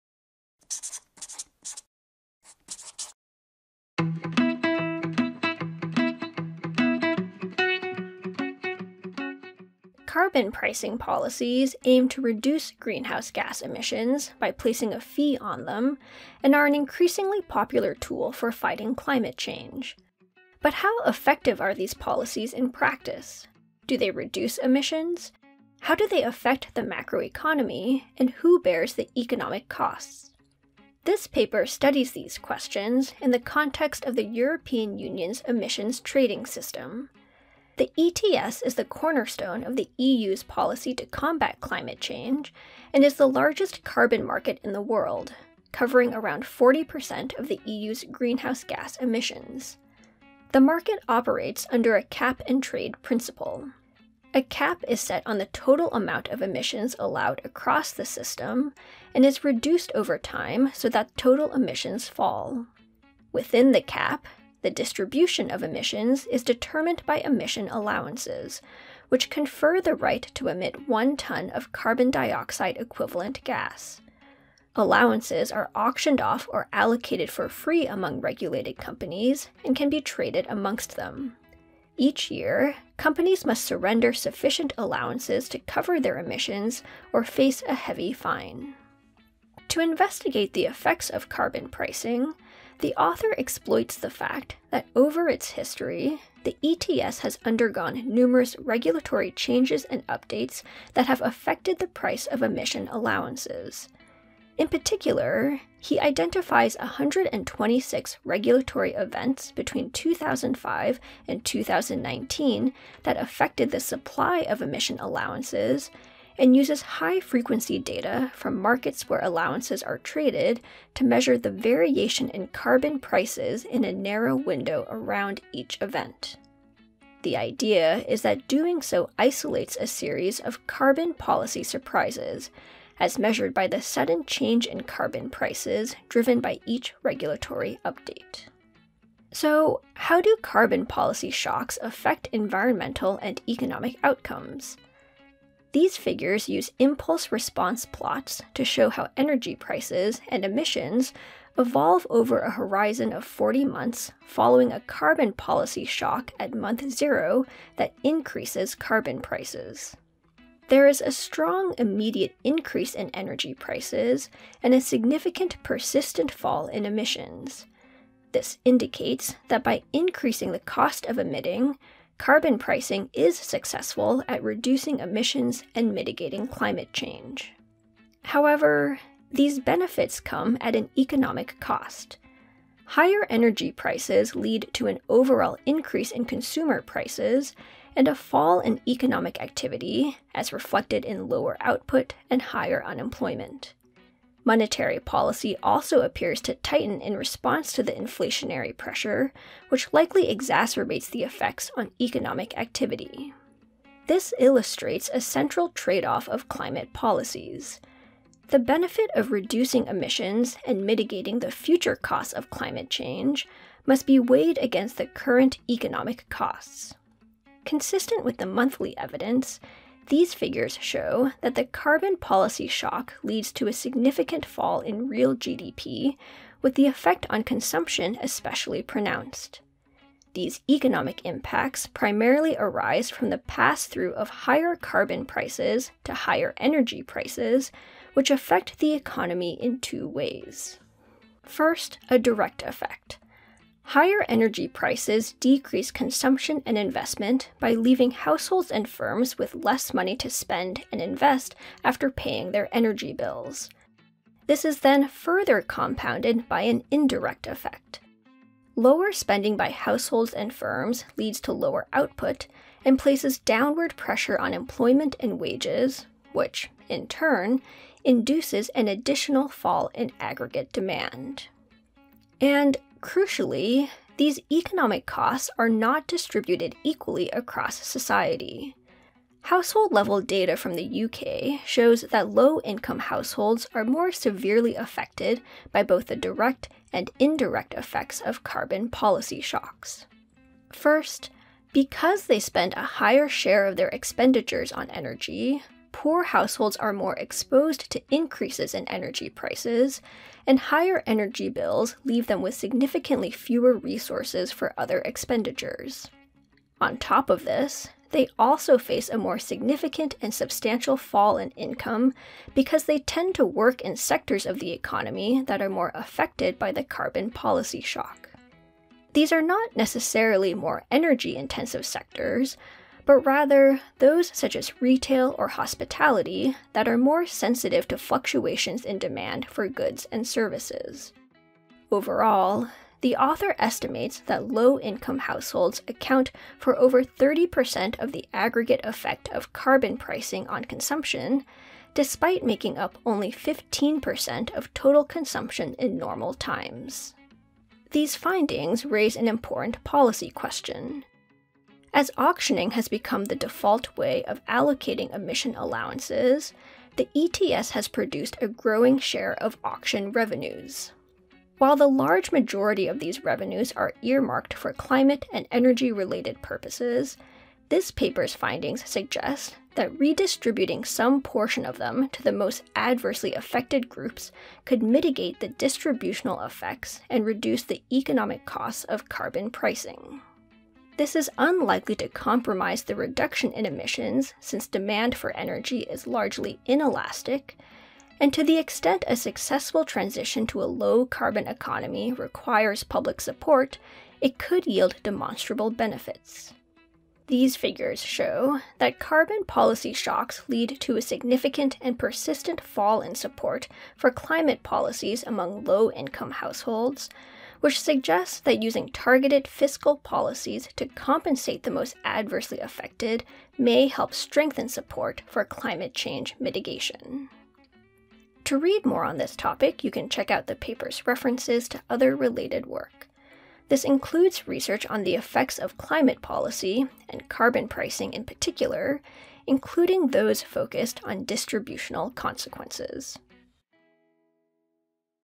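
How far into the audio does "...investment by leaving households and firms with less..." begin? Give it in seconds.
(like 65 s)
246 s.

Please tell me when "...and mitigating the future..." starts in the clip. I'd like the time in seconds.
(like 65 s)
210 s.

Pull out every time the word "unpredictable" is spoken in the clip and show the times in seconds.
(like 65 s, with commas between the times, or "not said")
not said.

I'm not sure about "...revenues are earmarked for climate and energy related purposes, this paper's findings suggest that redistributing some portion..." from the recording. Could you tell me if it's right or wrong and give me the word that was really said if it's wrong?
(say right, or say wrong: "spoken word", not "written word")
right.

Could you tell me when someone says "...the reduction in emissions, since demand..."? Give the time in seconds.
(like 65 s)
382 s.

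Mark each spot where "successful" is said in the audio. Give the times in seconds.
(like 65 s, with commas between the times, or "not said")
173 s, 389 s.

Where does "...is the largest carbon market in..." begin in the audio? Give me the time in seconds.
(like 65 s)
43 s.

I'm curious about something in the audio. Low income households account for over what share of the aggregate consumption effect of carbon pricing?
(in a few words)
30%.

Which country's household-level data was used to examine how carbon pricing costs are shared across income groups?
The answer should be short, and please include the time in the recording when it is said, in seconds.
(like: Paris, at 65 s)
UK, at 281 s.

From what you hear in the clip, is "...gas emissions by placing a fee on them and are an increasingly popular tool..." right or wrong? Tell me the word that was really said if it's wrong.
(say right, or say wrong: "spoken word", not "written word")
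right.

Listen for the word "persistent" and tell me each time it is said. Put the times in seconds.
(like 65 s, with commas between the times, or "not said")
165 s, 401 s.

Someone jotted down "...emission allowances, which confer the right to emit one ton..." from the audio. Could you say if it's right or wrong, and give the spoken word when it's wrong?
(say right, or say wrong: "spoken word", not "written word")
right.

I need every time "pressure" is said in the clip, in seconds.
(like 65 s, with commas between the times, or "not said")
198 s, 263 s.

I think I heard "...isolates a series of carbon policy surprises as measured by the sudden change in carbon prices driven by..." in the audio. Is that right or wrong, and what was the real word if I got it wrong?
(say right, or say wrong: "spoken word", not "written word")
right.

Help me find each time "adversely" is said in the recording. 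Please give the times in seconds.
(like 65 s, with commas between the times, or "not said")
372 s, 412 s.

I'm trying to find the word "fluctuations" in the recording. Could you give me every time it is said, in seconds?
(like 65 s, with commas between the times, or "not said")
327 s.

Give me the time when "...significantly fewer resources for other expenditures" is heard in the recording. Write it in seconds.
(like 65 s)
302 s.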